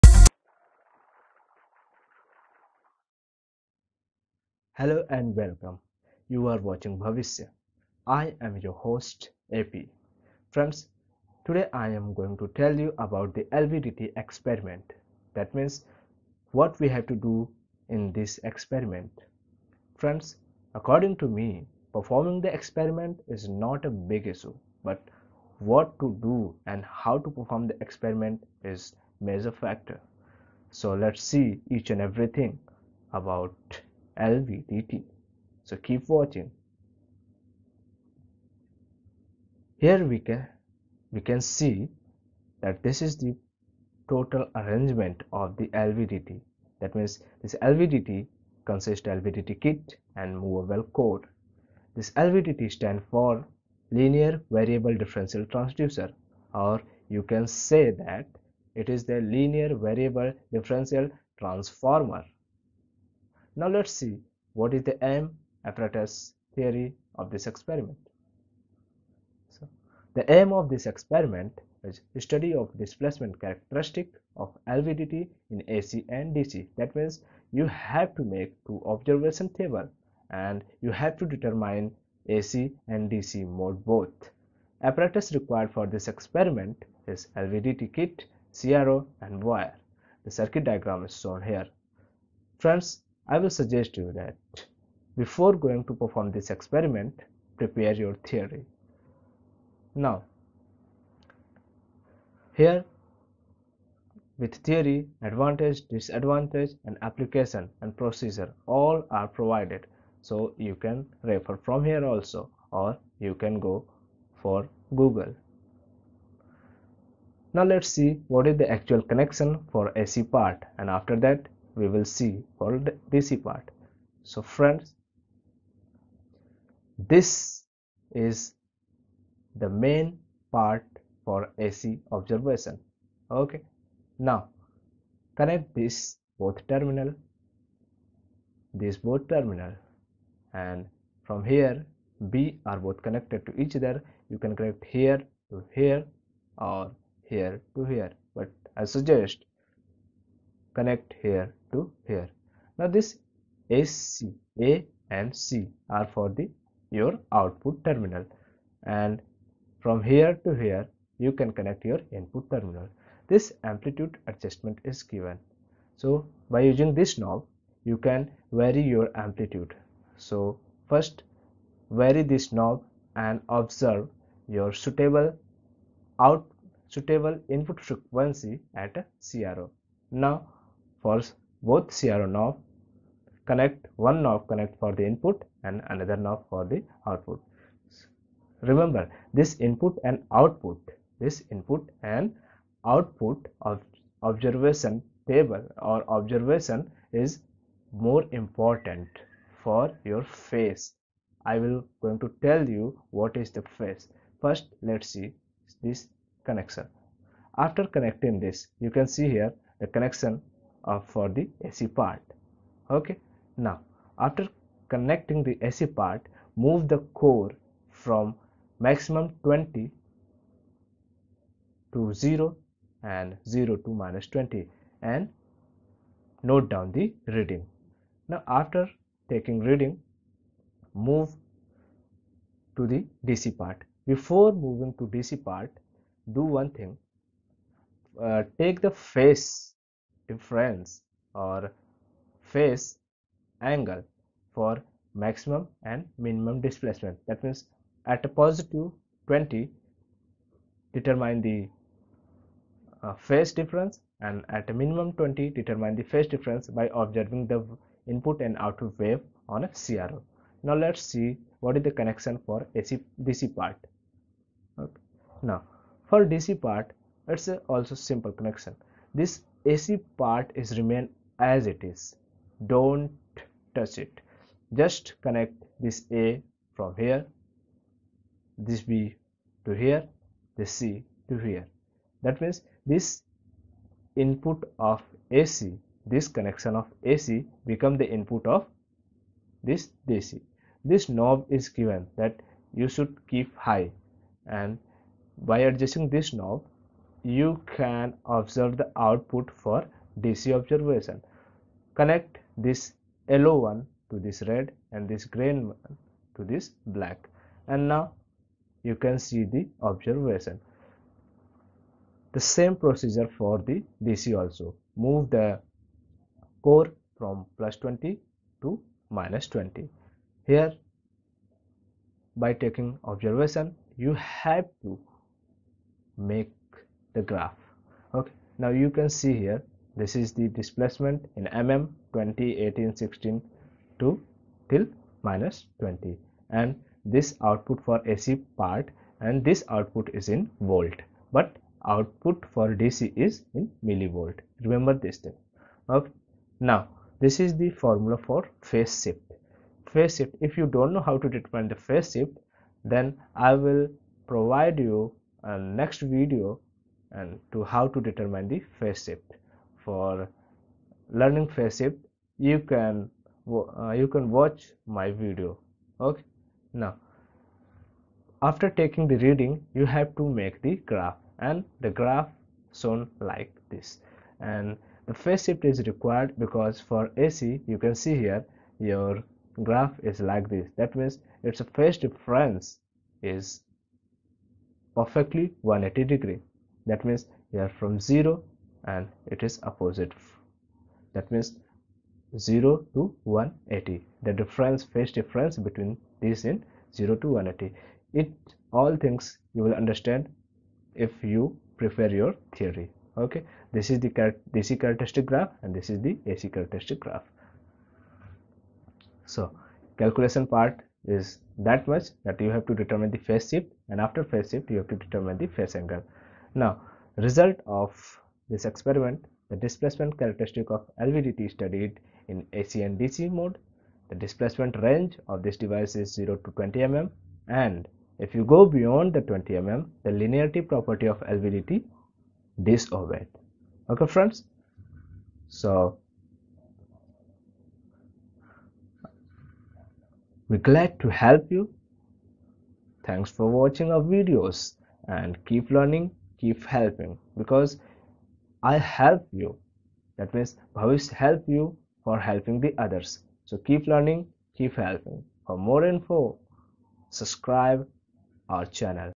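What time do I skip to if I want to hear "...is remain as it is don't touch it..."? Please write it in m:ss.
4:30.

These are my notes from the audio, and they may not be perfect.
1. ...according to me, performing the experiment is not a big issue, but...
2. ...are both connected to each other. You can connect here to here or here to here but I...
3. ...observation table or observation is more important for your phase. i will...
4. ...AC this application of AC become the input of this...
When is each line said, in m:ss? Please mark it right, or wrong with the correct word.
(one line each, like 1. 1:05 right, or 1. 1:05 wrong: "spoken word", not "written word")
1. 0:20 right
2. 2:22 right
3. 3:14 right
4. 4:45 wrong: "connection", not "application".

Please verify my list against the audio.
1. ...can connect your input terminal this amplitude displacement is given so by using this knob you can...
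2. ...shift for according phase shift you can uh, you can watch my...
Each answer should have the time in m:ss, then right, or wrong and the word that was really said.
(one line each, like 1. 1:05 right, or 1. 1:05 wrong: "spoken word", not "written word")
1. 2:41 wrong: "adjustment", not "displacement"
2. 5:59 wrong: "learning", not "according".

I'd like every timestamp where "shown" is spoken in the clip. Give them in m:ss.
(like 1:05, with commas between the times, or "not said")
1:31, 6:12.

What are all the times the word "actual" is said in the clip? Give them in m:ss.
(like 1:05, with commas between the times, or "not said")
1:58.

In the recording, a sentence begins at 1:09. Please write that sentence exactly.
So, the aim of this experiment is study of displacement characteristic of LVDT in AC and DC.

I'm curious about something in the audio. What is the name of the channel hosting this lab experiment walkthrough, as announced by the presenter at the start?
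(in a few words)
Bhavishya.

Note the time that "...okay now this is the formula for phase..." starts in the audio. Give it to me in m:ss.
5:45.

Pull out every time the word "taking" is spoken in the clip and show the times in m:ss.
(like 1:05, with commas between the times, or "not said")
3:49, 5:22, 6:08.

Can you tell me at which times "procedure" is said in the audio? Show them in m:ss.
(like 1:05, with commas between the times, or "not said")
1:47, 5:12.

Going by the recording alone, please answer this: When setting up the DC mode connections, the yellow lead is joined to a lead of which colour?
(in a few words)
Red.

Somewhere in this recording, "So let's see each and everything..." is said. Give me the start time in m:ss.
0:30.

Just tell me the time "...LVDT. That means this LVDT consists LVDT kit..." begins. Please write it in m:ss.
0:45.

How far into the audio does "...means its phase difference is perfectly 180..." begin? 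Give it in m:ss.
6:20.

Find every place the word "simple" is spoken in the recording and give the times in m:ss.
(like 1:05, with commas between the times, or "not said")
4:28.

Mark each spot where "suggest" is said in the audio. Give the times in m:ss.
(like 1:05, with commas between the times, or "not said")
1:33, 2:28.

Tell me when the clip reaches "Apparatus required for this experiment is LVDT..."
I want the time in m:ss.
1:24.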